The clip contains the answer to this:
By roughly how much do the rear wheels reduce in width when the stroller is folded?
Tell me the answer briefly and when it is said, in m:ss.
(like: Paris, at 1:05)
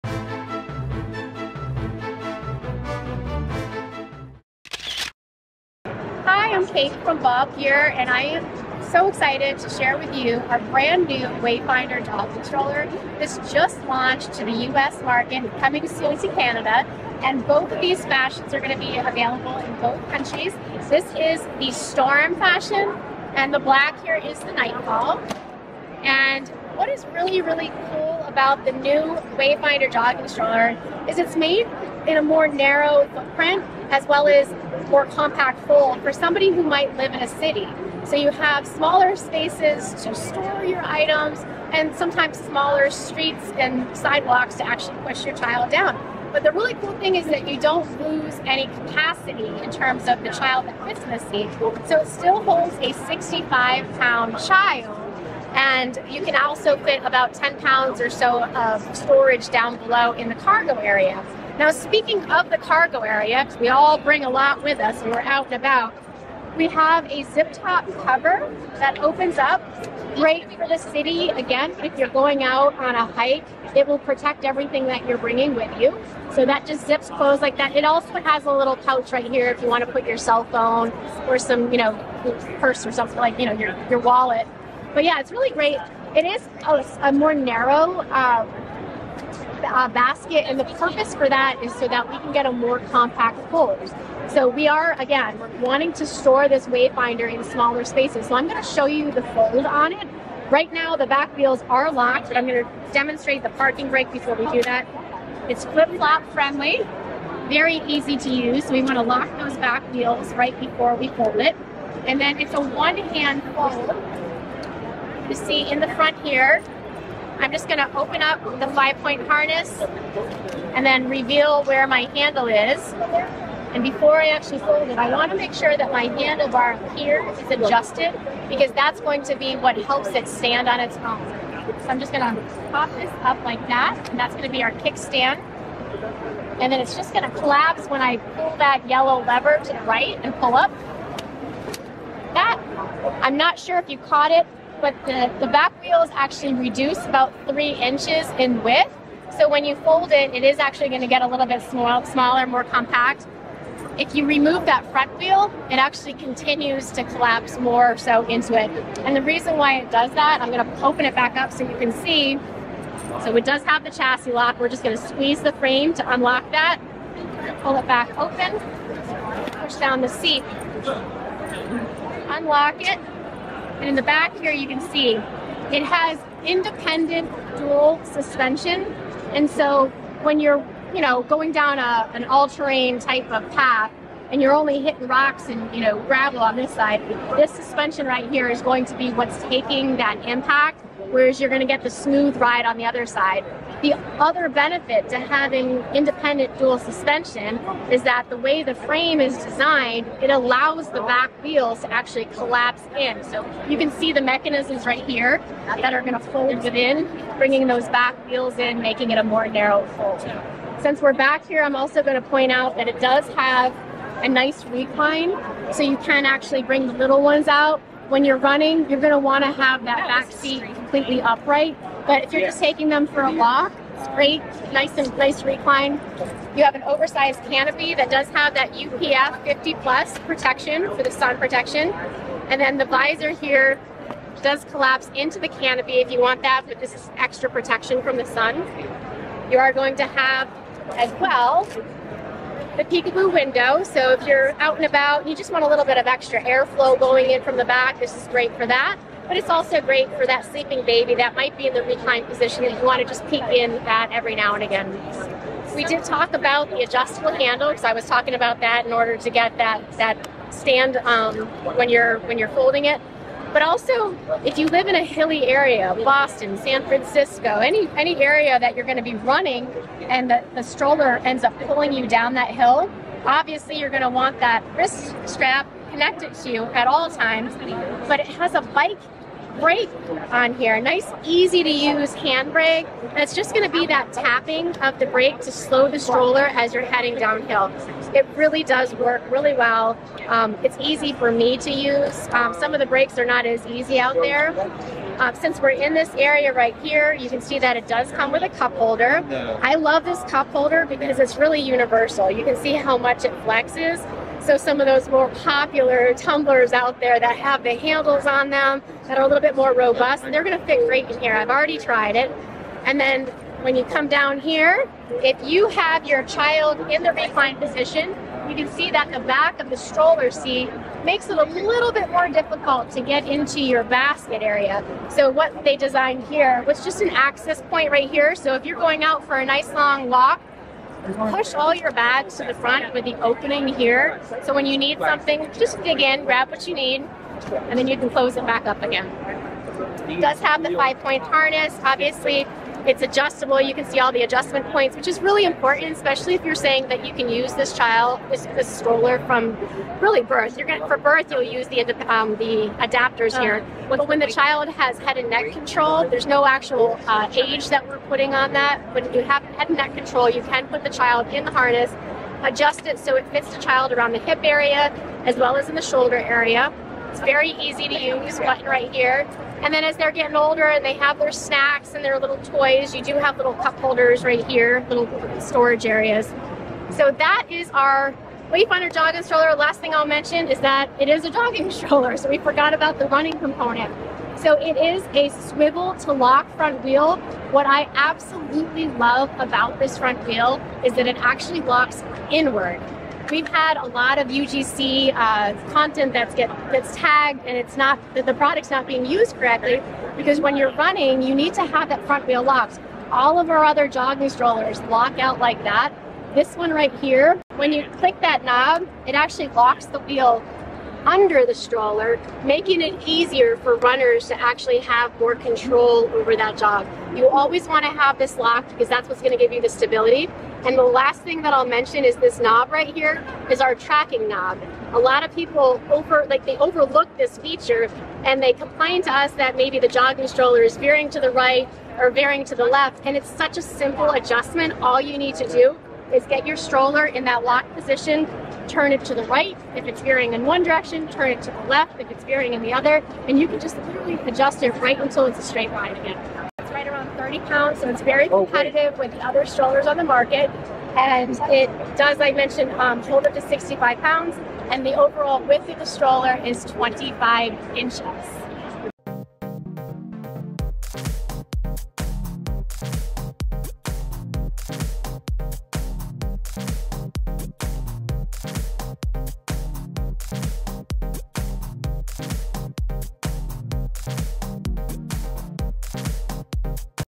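3 inches, at 2:27.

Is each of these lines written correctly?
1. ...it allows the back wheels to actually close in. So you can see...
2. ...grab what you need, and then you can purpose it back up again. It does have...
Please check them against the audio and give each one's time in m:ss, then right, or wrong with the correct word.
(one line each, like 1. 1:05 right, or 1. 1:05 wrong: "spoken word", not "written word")
1. 3:20 wrong: "collapse", not "close"
2. 5:36 wrong: "close", not "purpose".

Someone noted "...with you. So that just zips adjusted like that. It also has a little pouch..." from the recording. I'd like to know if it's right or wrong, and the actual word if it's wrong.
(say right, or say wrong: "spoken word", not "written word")
wrong: "closed", not "adjusted".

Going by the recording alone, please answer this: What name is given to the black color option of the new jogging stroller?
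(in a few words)
Nightfall.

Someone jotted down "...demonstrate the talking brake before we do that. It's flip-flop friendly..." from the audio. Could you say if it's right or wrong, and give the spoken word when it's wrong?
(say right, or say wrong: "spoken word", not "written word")
wrong: "parking", not "talking".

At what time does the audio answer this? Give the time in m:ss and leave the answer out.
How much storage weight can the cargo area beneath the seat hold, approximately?
0:57.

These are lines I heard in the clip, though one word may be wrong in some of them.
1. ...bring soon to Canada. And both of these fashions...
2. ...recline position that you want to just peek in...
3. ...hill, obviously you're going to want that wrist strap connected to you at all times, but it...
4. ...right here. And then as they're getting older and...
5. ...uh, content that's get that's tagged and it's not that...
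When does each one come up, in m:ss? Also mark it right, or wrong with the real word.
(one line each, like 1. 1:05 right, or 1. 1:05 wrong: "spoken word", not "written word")
1. 0:15 wrong: "coming", not "bring"
2. 4:11 right
3. 4:32 right
4. 6:08 right
5. 6:35 right.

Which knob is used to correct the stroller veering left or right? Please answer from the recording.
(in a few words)
tracking knob.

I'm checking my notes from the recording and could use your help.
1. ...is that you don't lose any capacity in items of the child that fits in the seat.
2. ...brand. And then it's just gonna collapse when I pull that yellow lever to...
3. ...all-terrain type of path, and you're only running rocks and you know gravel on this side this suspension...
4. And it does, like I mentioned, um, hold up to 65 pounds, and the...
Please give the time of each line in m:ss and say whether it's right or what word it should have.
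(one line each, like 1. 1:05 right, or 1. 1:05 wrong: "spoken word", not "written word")
1. 0:47 wrong: "terms", not "items"
2. 2:14 wrong: "kickstand", not "brand"
3. 3:02 wrong: "hitting", not "running"
4. 7:30 right.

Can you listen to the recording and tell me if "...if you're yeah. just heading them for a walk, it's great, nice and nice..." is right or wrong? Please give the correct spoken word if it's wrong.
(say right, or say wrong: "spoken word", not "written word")
wrong: "taking", not "heading".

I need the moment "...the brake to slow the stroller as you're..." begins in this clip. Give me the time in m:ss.
4:44.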